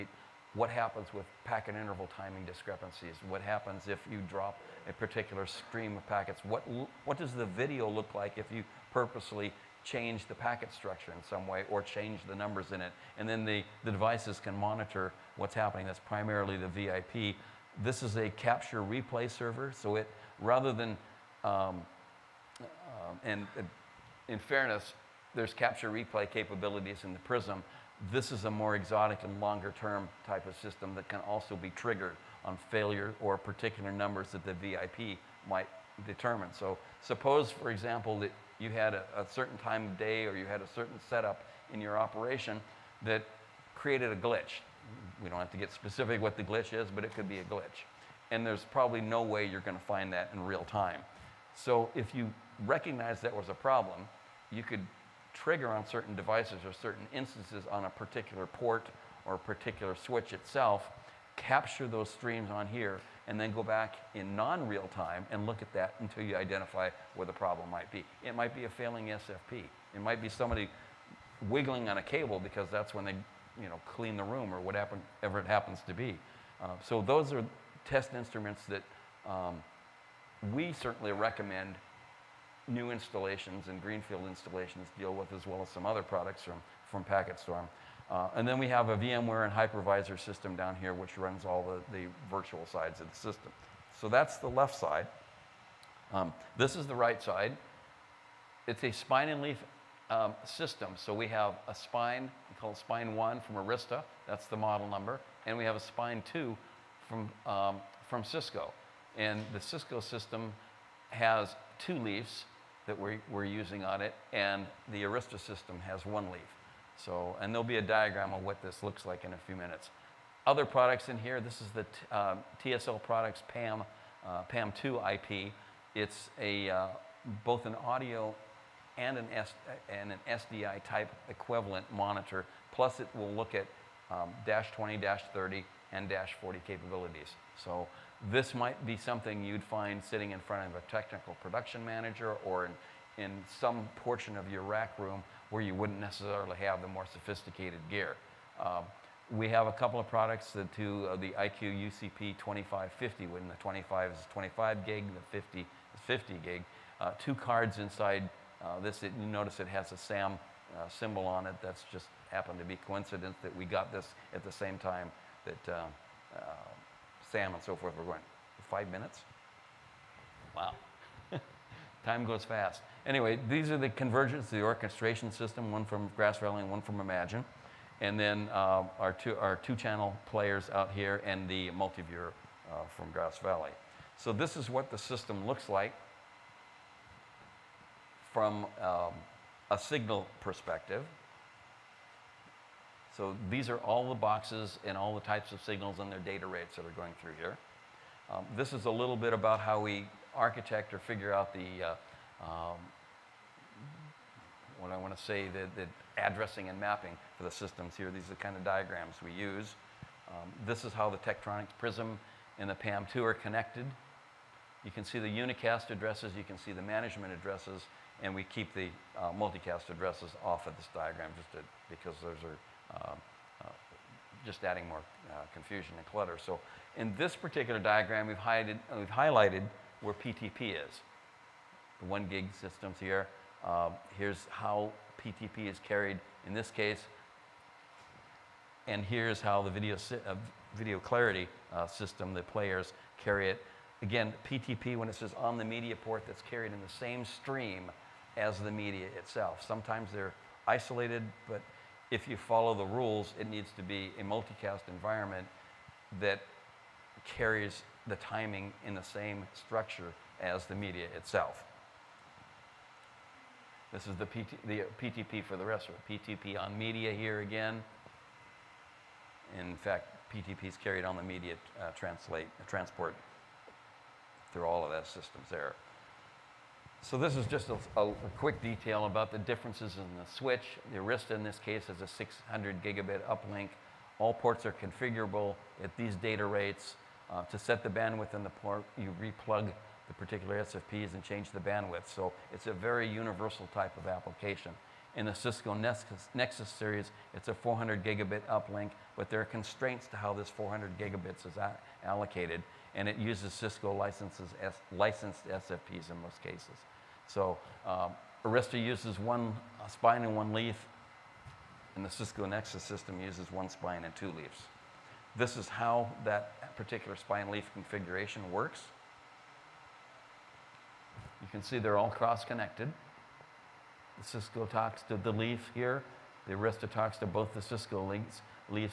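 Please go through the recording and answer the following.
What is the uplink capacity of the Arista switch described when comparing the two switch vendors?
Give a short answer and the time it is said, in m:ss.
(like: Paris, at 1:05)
600 gigabit, at 4:42.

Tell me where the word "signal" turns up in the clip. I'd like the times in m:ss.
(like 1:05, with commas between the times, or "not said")
3:09, 3:15.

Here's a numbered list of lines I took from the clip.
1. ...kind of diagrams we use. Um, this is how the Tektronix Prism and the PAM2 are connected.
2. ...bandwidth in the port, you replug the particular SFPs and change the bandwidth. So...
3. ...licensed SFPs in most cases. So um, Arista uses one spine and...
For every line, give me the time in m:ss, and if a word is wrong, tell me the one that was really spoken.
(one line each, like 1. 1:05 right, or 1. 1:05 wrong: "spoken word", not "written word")
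1. 3:28 right
2. 4:47 right
3. 5:04 right.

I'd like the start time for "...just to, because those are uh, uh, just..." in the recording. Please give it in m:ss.
3:41.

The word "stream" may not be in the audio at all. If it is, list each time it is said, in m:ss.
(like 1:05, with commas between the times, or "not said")
0:05, 1:02, 4:07.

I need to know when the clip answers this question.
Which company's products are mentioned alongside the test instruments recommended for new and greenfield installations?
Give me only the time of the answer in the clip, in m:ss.
1:27.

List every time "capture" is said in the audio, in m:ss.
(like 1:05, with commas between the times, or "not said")
0:18, 0:25, 1:01.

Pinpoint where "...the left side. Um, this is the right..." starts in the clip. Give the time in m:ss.
1:34.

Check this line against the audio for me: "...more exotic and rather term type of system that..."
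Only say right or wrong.
wrong.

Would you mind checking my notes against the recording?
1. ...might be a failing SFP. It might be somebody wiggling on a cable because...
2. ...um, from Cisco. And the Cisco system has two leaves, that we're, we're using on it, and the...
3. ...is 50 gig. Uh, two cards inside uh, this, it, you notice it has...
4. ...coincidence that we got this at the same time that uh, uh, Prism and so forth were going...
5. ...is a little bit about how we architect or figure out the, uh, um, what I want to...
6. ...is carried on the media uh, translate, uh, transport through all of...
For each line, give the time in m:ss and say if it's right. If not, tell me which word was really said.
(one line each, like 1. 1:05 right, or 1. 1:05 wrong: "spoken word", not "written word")
1. 1:08 right
2. 1:47 right
3. 2:35 right
4. 2:42 wrong: "Sam", not "Prism"
5. 3:18 right
6. 4:30 right.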